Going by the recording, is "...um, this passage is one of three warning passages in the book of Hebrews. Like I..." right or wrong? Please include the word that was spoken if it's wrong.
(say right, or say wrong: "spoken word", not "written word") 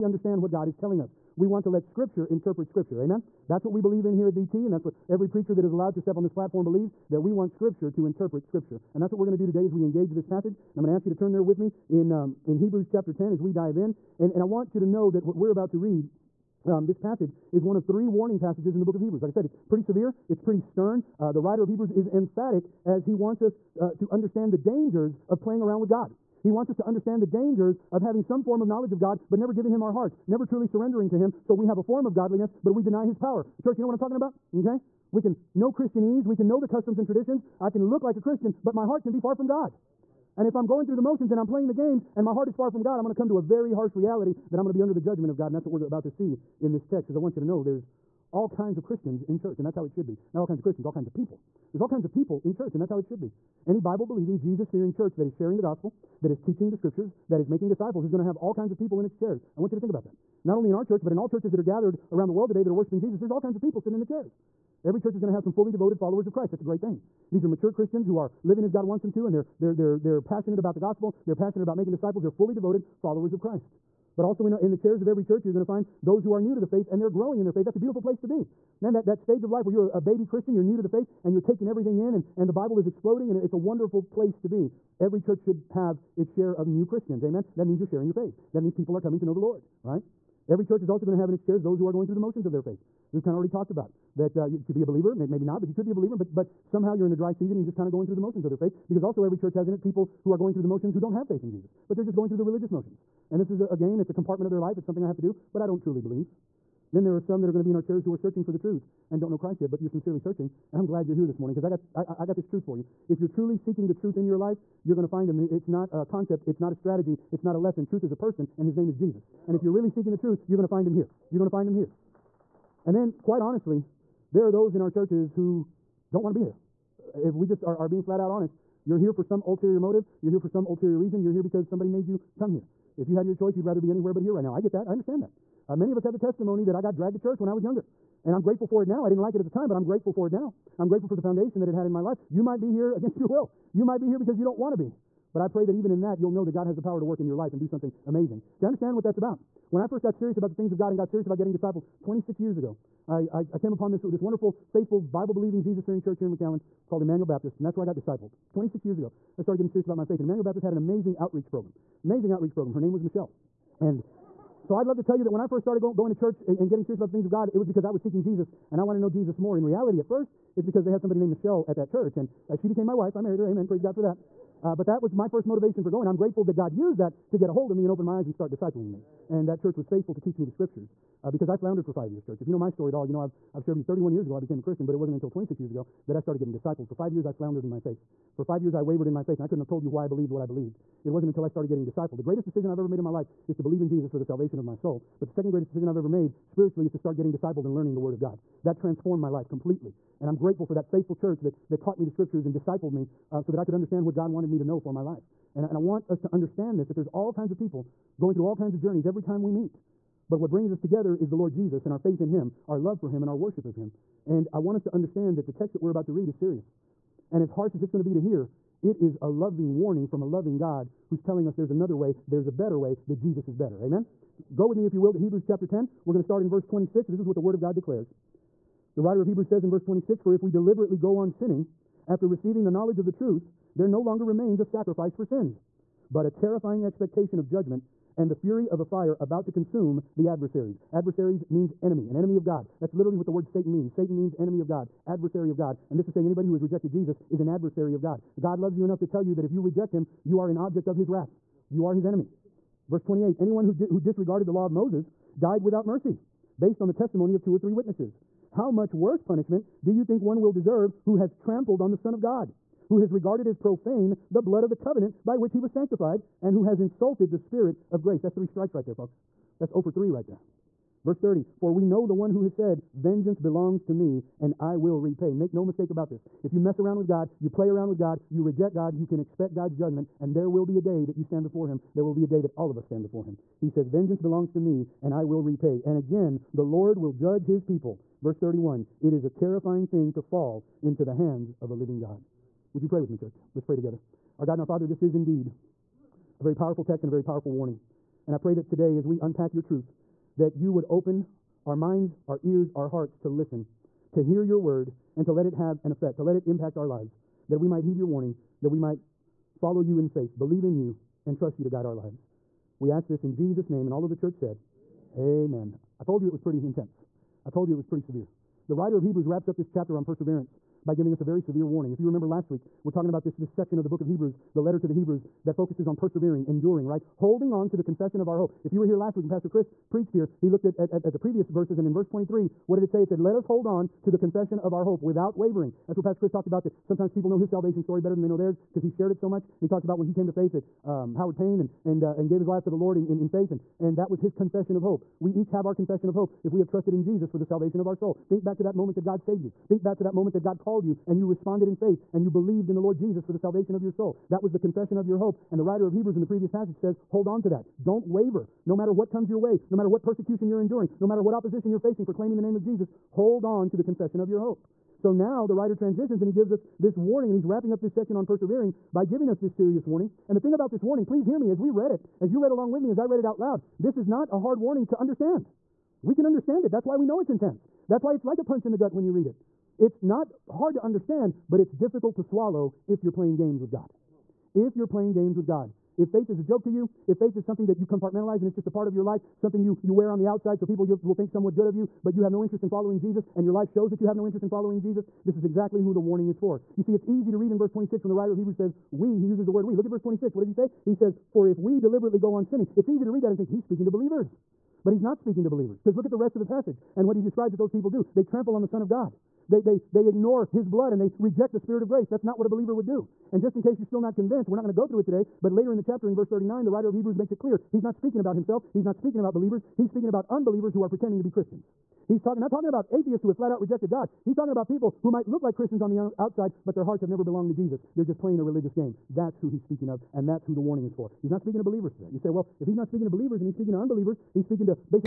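right.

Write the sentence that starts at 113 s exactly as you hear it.
If you're truly seeking the truth in your life, you're going to find him.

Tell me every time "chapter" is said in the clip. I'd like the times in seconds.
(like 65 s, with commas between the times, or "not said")
12 s, 225 s, 319 s, 415 s.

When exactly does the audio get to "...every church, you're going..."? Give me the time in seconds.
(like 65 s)
75 s.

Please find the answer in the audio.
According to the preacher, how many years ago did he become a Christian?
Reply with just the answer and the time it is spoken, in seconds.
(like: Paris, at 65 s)
31, at 183 s.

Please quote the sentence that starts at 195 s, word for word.
But the second greatest decision I've ever made spiritually is to start getting discipled and learning the Word of God.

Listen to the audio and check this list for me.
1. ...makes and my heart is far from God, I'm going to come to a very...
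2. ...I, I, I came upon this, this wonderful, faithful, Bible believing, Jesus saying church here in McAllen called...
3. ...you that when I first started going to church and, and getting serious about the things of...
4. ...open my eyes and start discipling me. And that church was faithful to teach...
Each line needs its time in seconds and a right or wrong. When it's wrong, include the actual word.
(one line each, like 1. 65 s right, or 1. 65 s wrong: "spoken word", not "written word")
1. 41 s wrong: "games", not "makes"
2. 153 s wrong: "fearing", not "saying"
3. 165 s right
4. 177 s right.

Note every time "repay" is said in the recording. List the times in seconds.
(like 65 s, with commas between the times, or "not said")
274 s, 285 s.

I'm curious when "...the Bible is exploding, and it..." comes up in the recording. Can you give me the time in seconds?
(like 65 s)
82 s.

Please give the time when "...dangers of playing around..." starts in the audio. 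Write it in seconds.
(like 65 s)
24 s.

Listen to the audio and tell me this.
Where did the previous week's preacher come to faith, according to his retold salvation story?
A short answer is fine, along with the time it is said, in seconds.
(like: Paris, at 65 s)
Howard Payne, at 341 s.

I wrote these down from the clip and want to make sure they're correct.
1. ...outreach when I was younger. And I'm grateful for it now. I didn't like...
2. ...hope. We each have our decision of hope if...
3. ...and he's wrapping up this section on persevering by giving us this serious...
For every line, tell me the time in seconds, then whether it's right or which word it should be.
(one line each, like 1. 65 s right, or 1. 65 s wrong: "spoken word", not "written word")
1. 137 s wrong: "church", not "outreach"
2. 344 s wrong: "confession", not "decision"
3. 367 s right.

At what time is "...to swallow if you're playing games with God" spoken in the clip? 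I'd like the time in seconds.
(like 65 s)
382 s.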